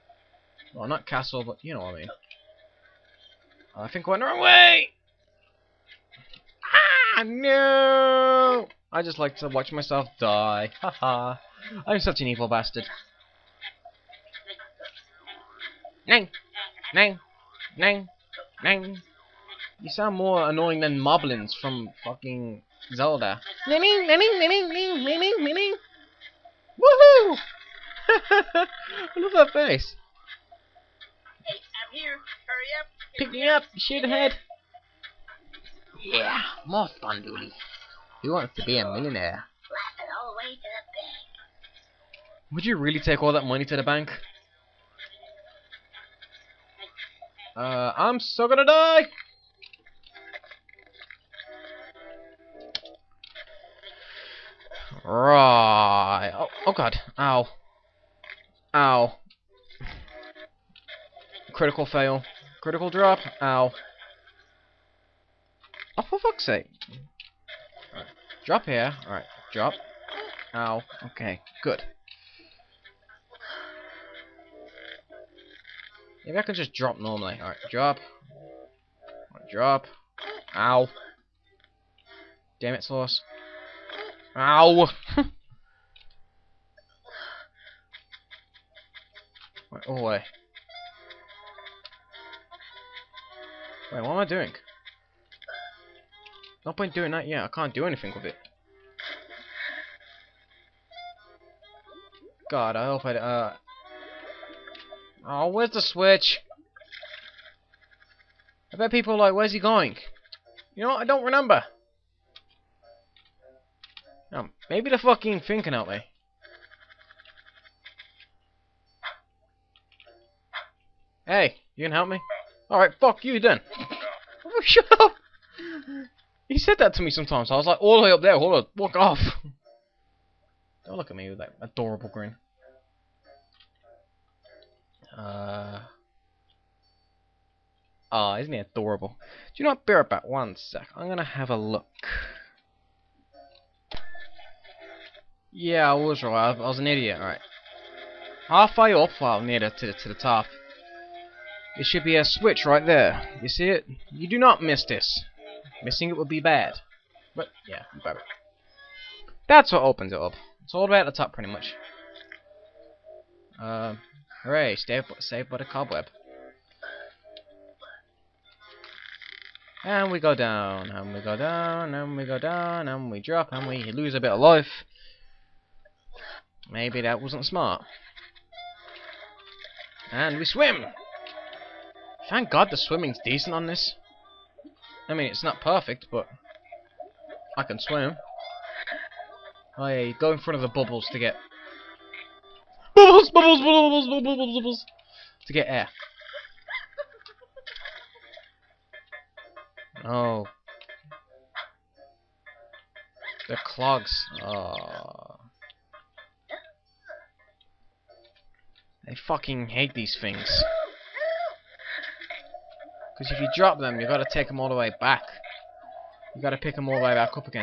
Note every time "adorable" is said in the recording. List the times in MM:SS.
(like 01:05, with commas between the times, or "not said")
02:11, 02:18.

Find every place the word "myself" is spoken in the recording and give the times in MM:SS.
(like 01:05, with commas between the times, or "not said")
00:09.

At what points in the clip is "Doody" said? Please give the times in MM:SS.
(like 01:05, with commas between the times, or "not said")
00:37.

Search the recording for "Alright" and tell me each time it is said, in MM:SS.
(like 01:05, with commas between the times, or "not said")
01:09, 01:17, 02:02.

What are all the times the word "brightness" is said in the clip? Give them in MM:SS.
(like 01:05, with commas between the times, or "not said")
not said.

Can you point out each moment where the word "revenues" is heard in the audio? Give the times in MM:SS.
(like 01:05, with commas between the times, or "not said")
not said.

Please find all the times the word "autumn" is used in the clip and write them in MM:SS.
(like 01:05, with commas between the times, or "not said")
not said.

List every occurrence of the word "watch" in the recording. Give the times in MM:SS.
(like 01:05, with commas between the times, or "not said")
00:09.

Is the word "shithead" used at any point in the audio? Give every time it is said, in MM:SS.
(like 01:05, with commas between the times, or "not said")
00:33.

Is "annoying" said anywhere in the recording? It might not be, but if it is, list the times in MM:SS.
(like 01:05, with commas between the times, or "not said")
00:20.